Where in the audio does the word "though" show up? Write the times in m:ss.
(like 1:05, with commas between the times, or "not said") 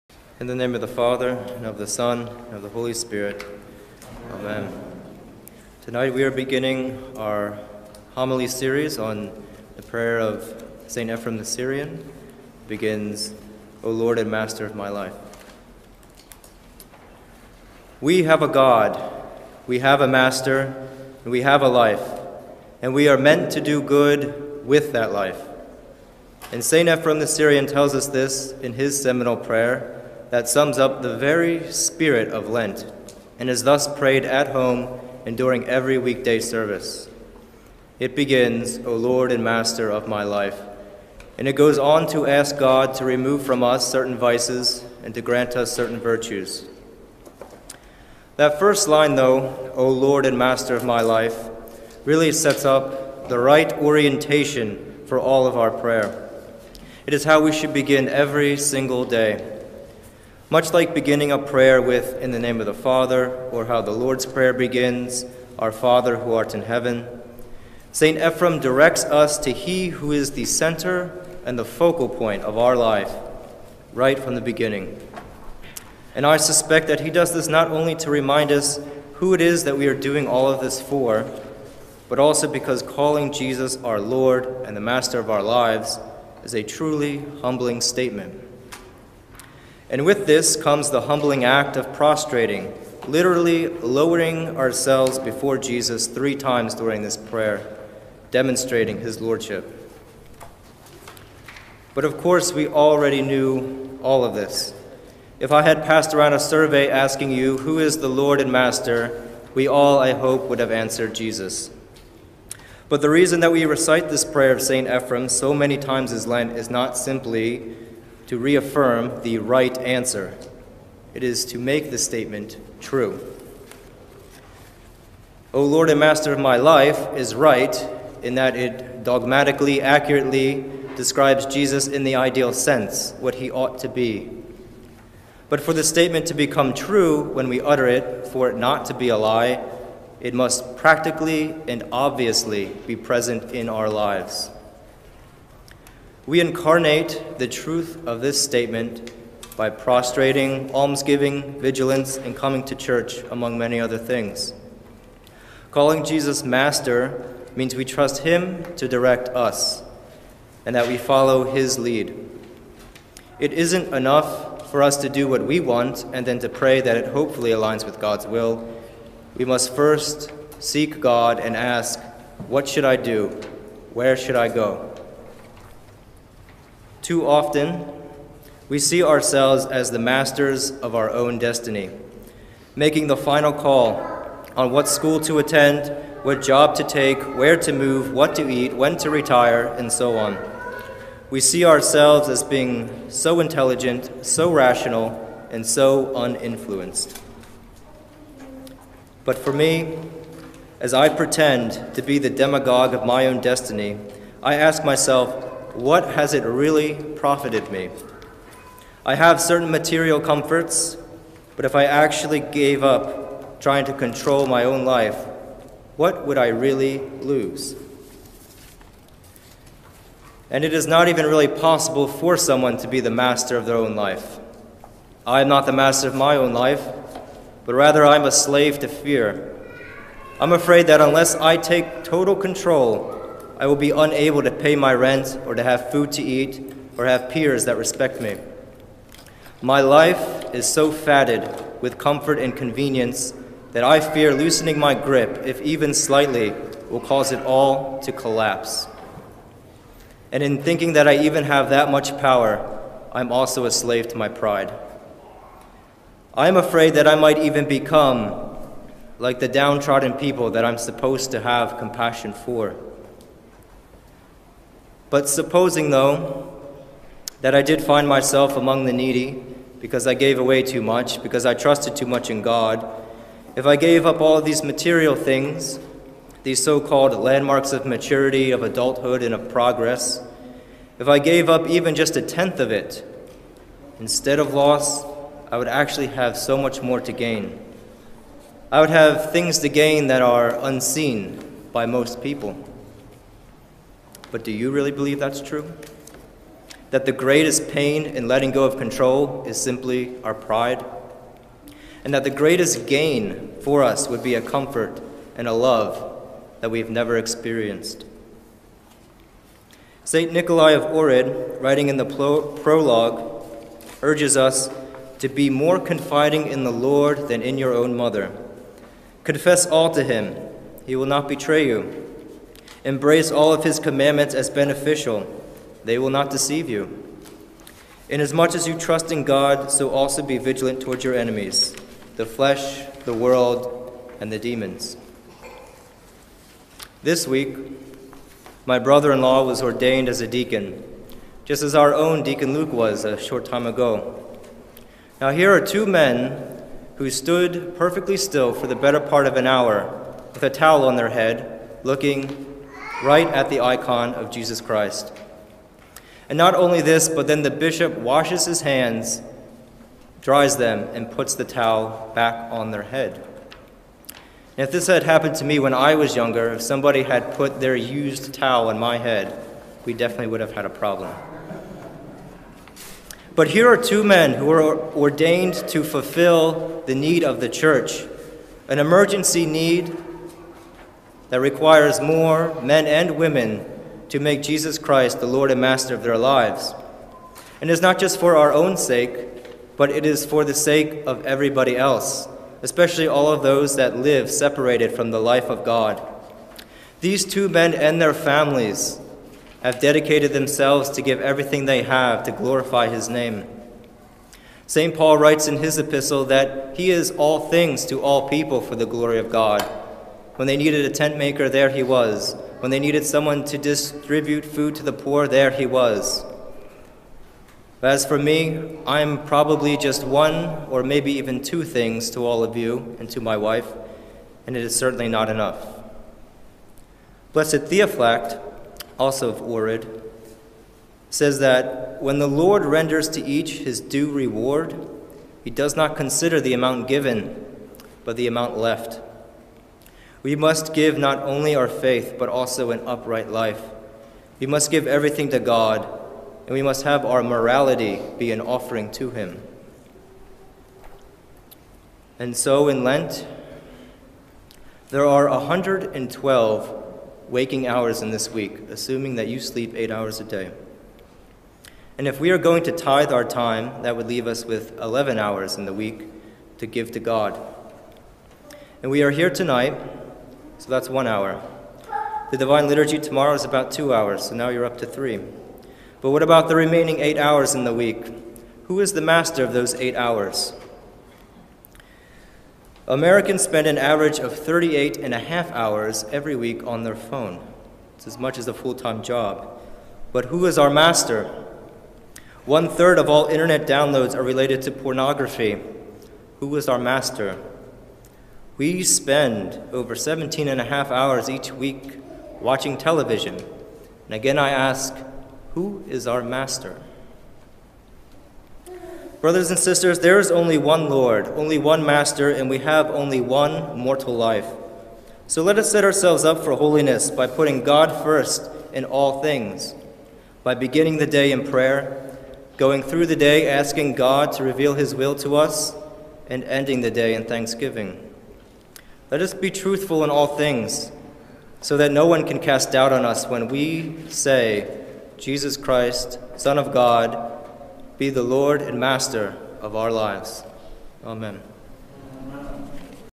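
0:49, 4:25.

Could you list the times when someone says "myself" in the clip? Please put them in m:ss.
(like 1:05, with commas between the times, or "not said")
3:24, 4:28.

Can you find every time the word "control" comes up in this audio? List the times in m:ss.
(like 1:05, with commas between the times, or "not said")
3:33, 3:52, 4:58.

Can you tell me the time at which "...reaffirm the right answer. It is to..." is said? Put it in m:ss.
1:58.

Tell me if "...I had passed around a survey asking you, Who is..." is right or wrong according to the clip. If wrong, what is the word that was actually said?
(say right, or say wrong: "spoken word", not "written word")
right.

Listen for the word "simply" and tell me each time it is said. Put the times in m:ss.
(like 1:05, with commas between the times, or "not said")
1:56, 4:59.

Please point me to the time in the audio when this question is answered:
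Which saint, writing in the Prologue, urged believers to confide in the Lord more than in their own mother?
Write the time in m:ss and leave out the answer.
5:10.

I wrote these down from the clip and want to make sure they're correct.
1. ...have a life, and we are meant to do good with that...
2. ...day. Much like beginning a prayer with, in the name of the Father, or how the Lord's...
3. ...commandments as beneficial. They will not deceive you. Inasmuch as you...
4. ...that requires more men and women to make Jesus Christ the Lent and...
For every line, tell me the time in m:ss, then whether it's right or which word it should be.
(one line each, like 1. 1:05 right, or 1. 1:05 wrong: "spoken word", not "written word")
1. 0:21 right
2. 0:59 right
3. 5:23 right
4. 6:21 wrong: "Lord", not "Lent".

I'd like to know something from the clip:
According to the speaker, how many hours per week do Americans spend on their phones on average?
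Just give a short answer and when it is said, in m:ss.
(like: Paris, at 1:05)
38.5, at 8:04.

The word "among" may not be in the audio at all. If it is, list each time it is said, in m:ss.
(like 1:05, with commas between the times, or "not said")
2:33, 4:28.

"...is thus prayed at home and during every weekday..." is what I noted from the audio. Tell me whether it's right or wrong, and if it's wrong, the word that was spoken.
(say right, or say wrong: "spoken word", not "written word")
right.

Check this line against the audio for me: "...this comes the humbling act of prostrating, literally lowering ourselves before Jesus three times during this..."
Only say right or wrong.
right.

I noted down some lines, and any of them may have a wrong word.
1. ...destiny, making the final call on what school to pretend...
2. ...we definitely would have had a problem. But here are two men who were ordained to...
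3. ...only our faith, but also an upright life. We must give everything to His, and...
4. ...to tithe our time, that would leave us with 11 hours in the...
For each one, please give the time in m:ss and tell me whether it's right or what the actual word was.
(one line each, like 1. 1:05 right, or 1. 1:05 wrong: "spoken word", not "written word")
1. 3:01 wrong: "attend", not "pretend"
2. 6:09 right
3. 7:21 wrong: "God", not "His"
4. 7:42 right.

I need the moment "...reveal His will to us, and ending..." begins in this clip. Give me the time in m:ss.
8:44.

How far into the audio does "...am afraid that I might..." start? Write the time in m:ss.
4:16.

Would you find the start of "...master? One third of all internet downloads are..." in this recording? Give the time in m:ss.
8:10.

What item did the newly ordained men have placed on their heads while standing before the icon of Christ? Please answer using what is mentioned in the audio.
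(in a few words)
a towel.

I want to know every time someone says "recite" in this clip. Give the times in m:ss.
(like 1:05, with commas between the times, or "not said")
1:53.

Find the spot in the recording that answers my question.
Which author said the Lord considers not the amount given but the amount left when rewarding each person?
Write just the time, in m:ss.
7:07.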